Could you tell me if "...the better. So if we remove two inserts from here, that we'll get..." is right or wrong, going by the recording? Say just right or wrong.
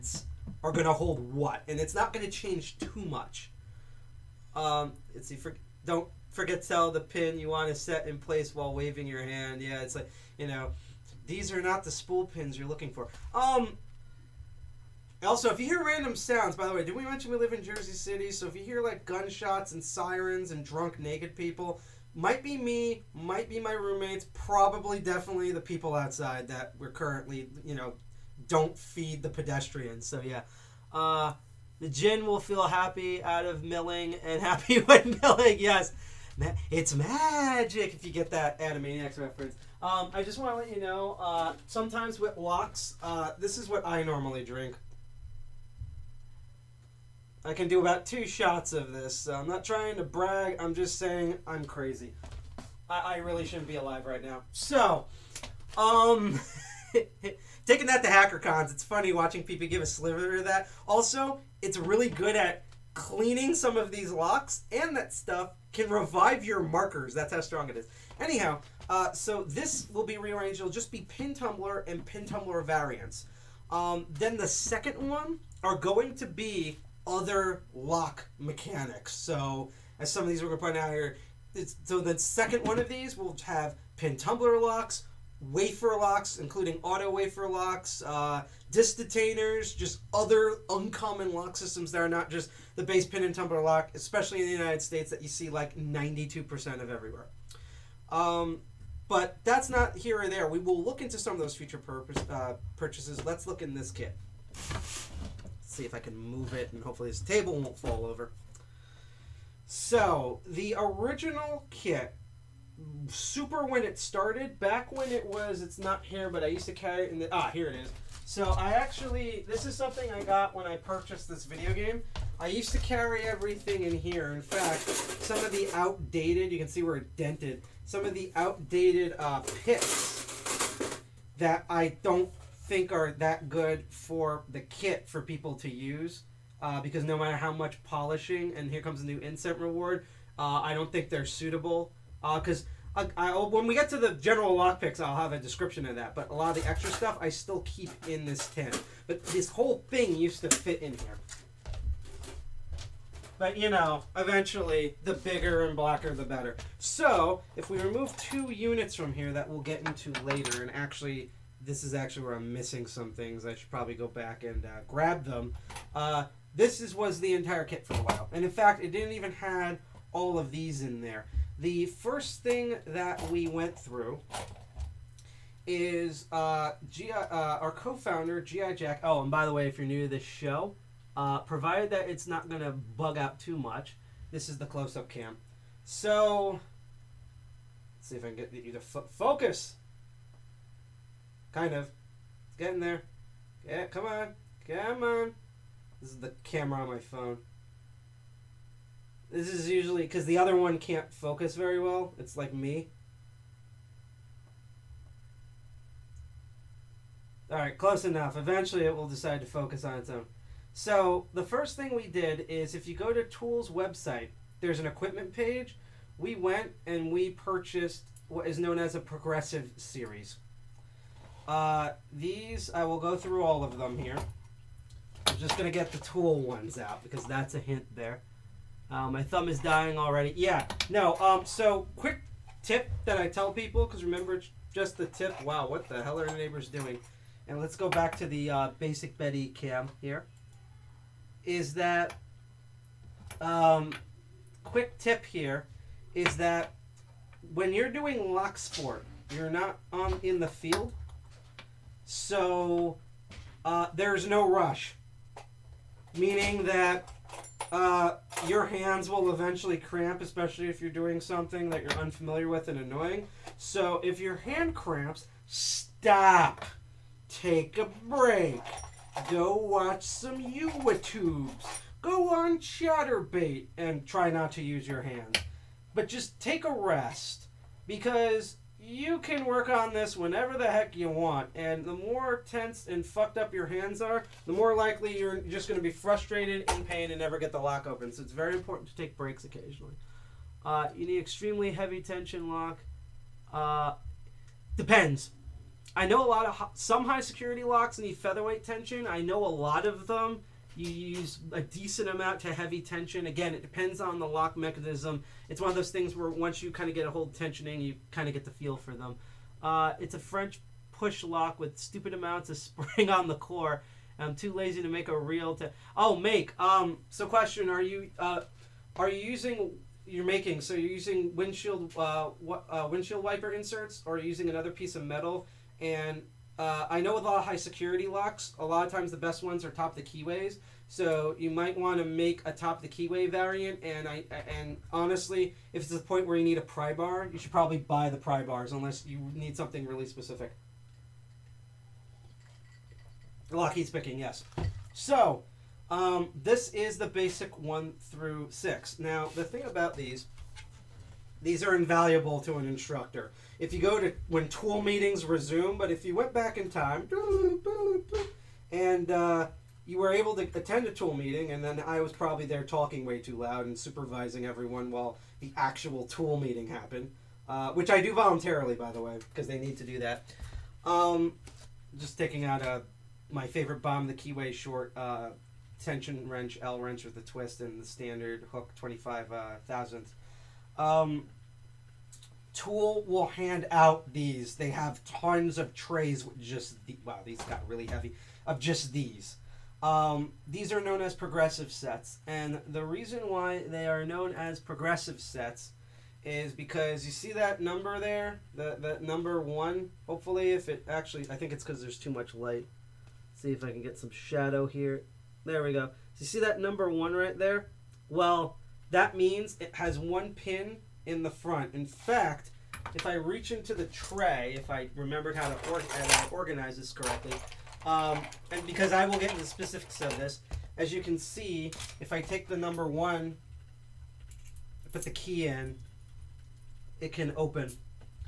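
wrong.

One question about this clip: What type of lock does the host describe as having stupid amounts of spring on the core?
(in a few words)
French push lock.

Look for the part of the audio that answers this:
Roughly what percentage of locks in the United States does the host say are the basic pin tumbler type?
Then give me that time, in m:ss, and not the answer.
1:35.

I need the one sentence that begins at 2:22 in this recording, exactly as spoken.
Because uh, I, I, when we get to the general lock picks, I'll have a description of that.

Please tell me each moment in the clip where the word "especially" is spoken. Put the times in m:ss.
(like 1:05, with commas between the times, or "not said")
1:33, 4:20.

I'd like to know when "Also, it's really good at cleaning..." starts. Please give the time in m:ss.
1:00.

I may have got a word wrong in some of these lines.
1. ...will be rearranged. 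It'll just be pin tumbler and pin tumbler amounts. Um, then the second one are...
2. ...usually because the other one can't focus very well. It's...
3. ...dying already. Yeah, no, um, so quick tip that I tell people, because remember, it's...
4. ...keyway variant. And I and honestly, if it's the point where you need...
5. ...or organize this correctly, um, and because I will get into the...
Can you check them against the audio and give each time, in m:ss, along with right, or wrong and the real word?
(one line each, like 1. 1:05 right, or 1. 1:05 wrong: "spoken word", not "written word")
1. 1:09 wrong: "variants", not "amounts"
2. 3:19 right
3. 3:49 right
4. 5:32 right
5. 6:55 right.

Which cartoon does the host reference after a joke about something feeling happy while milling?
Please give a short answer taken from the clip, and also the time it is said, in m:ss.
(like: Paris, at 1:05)
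Animaniacs, at 0:38.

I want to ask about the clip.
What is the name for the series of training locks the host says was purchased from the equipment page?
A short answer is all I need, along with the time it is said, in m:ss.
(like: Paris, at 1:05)
progressive series, at 3:38.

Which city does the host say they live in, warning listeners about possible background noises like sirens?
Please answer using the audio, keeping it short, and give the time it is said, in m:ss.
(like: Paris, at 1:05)
Jersey City, at 0:17.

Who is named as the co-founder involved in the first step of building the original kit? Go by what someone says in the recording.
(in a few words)
GI Jack.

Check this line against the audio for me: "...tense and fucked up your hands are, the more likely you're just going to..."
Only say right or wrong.
right.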